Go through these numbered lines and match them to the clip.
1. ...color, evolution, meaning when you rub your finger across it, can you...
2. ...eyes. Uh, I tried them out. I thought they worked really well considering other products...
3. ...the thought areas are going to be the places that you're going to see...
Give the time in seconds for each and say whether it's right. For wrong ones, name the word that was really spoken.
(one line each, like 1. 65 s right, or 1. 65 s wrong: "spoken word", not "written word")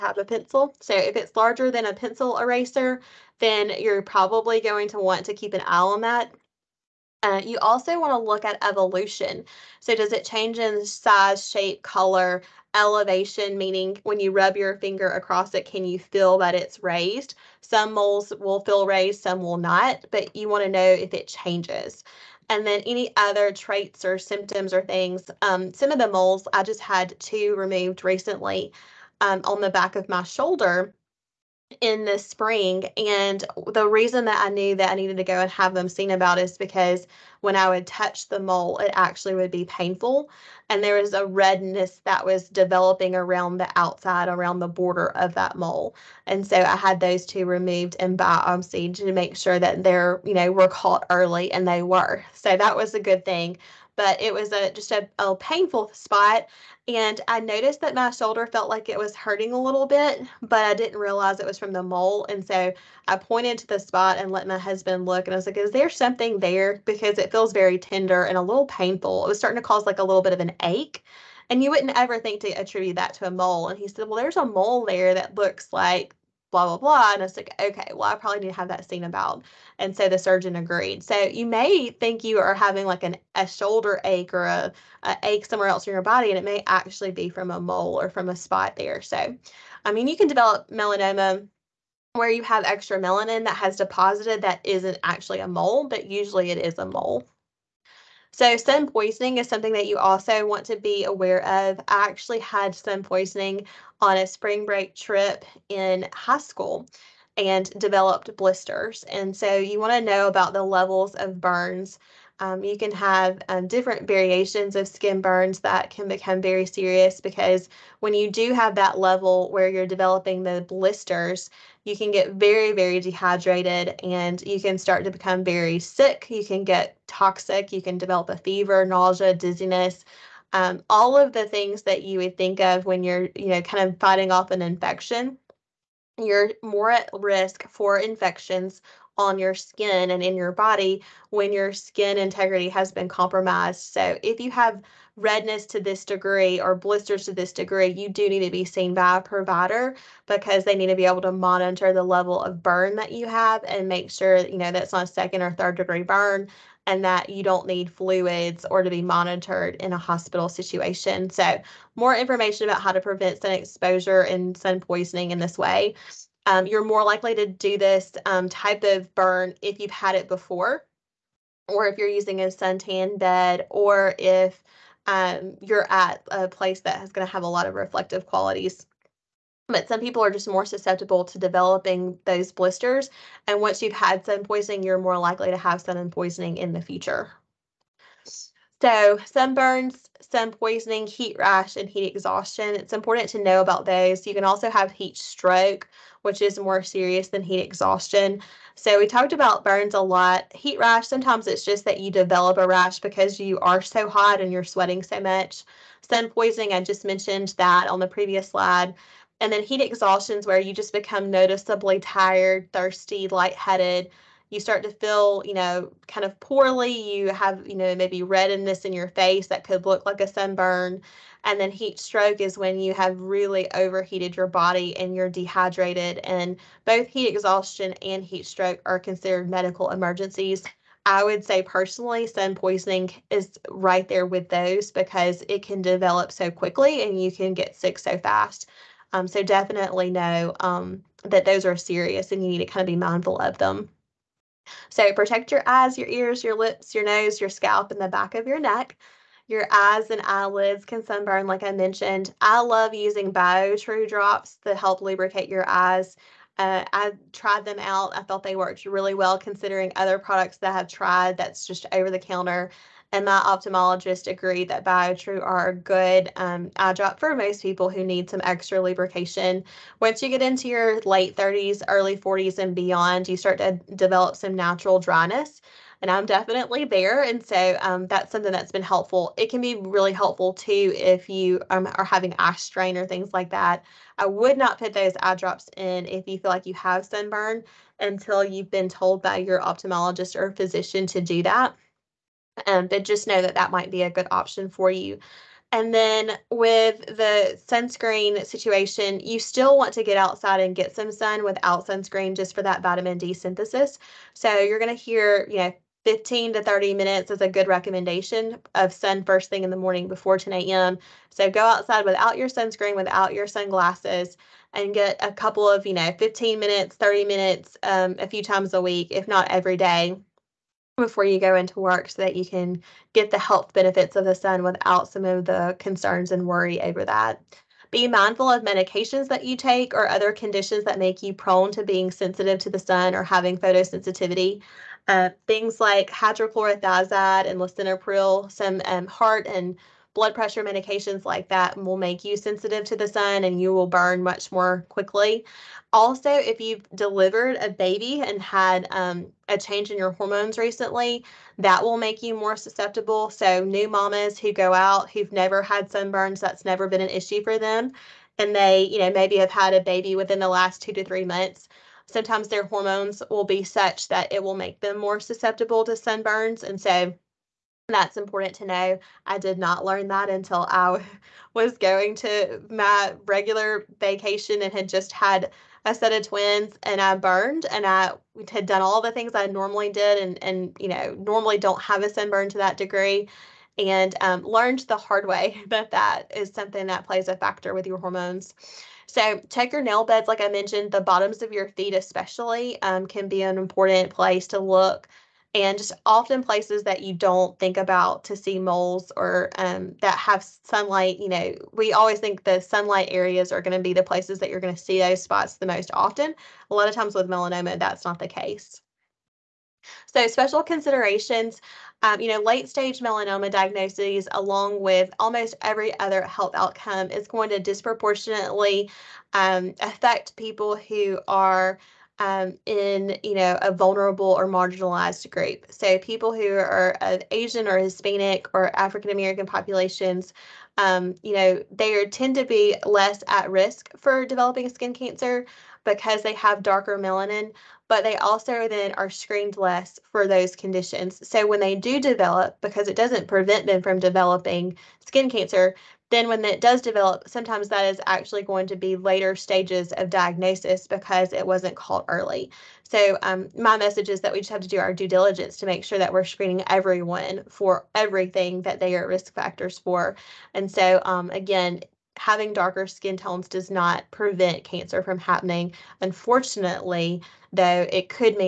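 1. 11 s wrong: "elevation", not "evolution"
2. 255 s right
3. 402 s wrong: "sunlight", not "thought".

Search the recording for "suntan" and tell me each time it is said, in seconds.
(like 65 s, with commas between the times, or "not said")
172 s.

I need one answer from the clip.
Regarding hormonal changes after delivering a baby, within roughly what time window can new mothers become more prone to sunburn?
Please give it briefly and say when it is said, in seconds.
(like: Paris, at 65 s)
2 to 3 months, at 360 s.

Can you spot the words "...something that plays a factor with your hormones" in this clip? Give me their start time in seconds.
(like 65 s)
386 s.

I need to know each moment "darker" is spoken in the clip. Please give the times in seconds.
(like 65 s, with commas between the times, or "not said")
436 s, 462 s.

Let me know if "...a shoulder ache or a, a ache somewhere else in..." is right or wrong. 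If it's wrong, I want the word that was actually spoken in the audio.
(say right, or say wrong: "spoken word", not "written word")
right.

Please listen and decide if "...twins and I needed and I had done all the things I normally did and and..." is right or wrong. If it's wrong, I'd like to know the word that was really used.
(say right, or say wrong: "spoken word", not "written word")
wrong: "burned", not "needed".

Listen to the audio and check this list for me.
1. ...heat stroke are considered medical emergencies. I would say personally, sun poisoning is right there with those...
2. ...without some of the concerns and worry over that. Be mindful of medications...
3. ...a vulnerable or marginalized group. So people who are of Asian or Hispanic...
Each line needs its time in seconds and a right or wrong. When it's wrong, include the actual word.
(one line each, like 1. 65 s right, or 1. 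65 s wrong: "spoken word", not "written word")
1. 228 s right
2. 324 s right
3. 423 s right.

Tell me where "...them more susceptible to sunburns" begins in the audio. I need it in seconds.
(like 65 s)
364 s.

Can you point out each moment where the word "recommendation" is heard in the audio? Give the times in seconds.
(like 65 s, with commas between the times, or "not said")
307 s.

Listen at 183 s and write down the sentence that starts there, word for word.
And once you've had sun poisoning, you're more likely to have sun poisoning in the future.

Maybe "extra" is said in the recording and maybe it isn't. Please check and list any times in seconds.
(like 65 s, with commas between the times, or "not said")
92 s, 268 s.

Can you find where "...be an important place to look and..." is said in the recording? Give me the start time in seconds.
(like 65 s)
393 s.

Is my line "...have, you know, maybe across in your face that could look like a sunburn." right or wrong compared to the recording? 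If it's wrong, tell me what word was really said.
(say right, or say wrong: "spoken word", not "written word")
wrong: "redness", not "across".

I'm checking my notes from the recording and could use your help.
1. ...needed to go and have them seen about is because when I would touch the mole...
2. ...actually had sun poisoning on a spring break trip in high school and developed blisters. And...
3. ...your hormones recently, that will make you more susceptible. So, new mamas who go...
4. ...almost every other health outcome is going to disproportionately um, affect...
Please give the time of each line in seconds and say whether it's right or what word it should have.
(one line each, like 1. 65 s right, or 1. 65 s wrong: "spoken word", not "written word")
1. 34 s right
2. 102 s right
3. 349 s right
4. 415 s right.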